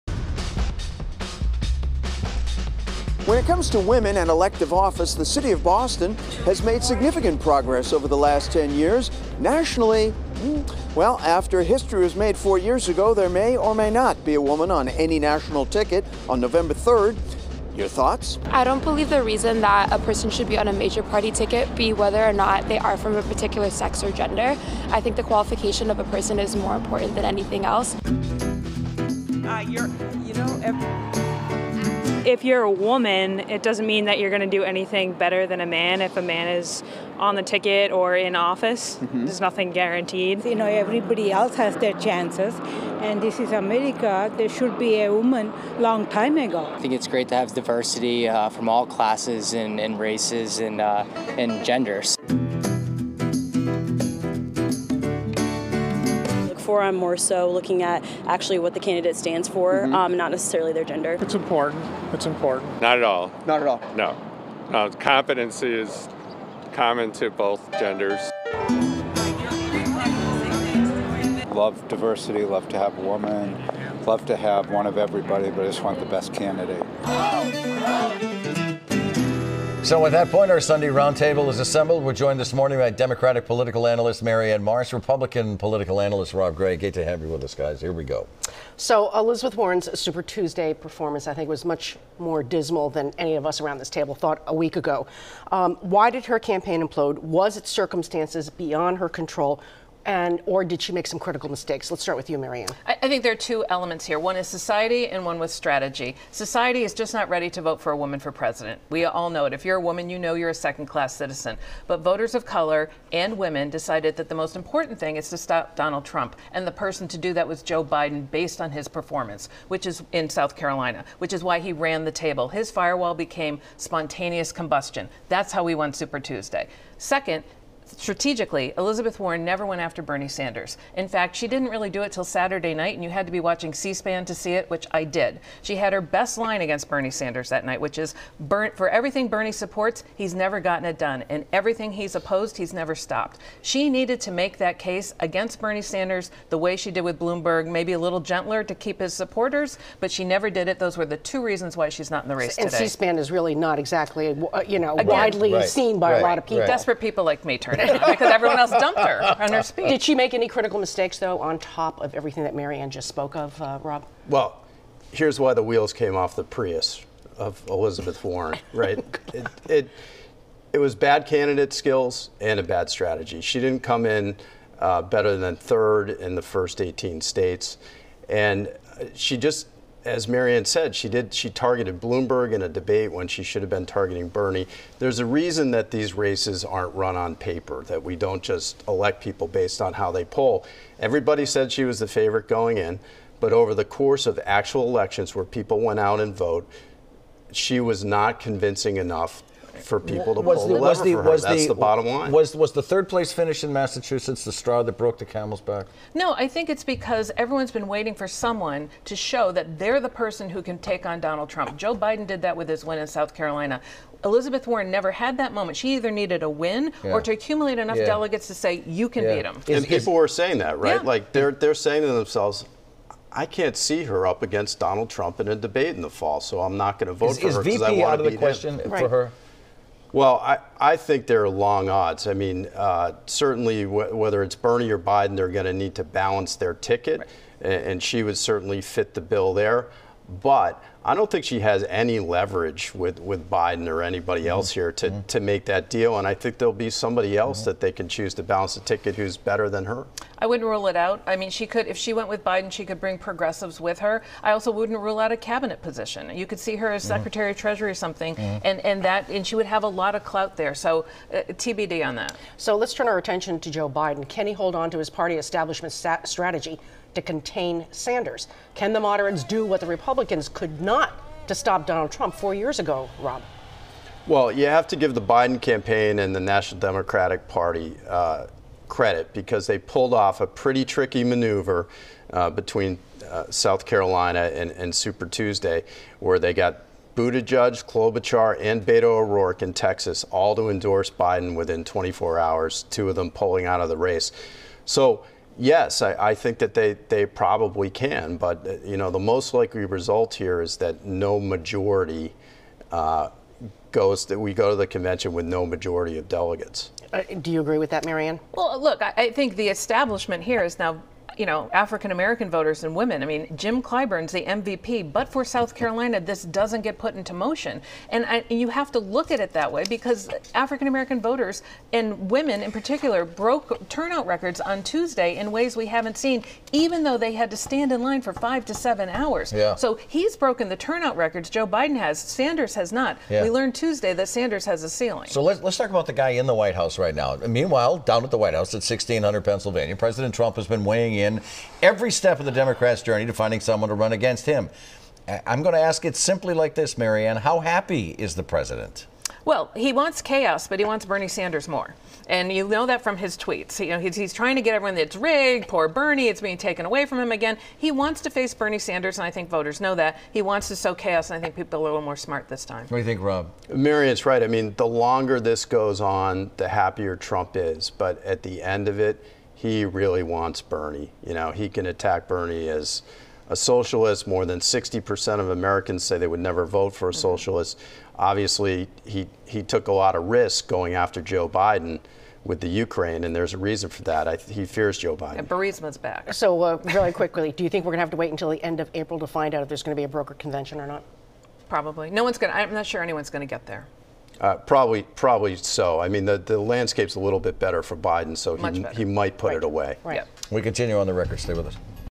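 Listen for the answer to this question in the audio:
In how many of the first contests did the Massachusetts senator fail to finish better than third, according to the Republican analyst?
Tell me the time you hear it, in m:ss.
2:56.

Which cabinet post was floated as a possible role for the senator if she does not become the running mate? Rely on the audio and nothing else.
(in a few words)
Secretary of Treasury.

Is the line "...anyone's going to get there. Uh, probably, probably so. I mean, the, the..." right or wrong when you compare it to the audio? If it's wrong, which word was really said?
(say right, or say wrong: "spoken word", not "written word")
right.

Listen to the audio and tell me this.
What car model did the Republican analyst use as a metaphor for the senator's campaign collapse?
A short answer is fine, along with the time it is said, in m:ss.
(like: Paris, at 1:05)
Prius, at 2:46.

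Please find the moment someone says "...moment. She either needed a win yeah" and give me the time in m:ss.
3:35.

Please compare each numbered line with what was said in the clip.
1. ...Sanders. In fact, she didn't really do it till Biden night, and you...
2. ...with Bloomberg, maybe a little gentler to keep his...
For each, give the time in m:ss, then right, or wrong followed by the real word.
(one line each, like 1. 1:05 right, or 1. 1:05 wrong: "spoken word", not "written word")
1. 2:10 wrong: "Saturday", not "Biden"
2. 2:27 right.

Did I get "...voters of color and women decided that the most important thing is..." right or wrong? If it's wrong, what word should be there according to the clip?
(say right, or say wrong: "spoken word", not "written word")
right.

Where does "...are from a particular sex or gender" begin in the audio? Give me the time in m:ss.
0:22.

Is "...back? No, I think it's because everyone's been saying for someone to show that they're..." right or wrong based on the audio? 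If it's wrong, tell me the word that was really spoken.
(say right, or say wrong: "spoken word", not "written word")
wrong: "waiting", not "saying".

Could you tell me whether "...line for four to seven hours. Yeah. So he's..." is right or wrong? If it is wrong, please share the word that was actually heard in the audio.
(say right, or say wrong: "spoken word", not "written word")
wrong: "five", not "four".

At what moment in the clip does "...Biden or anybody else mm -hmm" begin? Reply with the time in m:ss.
4:03.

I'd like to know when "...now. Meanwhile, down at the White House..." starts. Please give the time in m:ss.
5:37.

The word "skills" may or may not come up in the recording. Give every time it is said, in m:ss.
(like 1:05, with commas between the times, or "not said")
2:51.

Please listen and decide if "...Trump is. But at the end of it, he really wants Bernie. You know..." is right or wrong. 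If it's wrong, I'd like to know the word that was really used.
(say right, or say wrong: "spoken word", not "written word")
right.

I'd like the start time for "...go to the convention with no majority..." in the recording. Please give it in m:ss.
5:04.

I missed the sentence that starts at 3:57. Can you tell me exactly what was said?
and, and she would certainly fit the bill there.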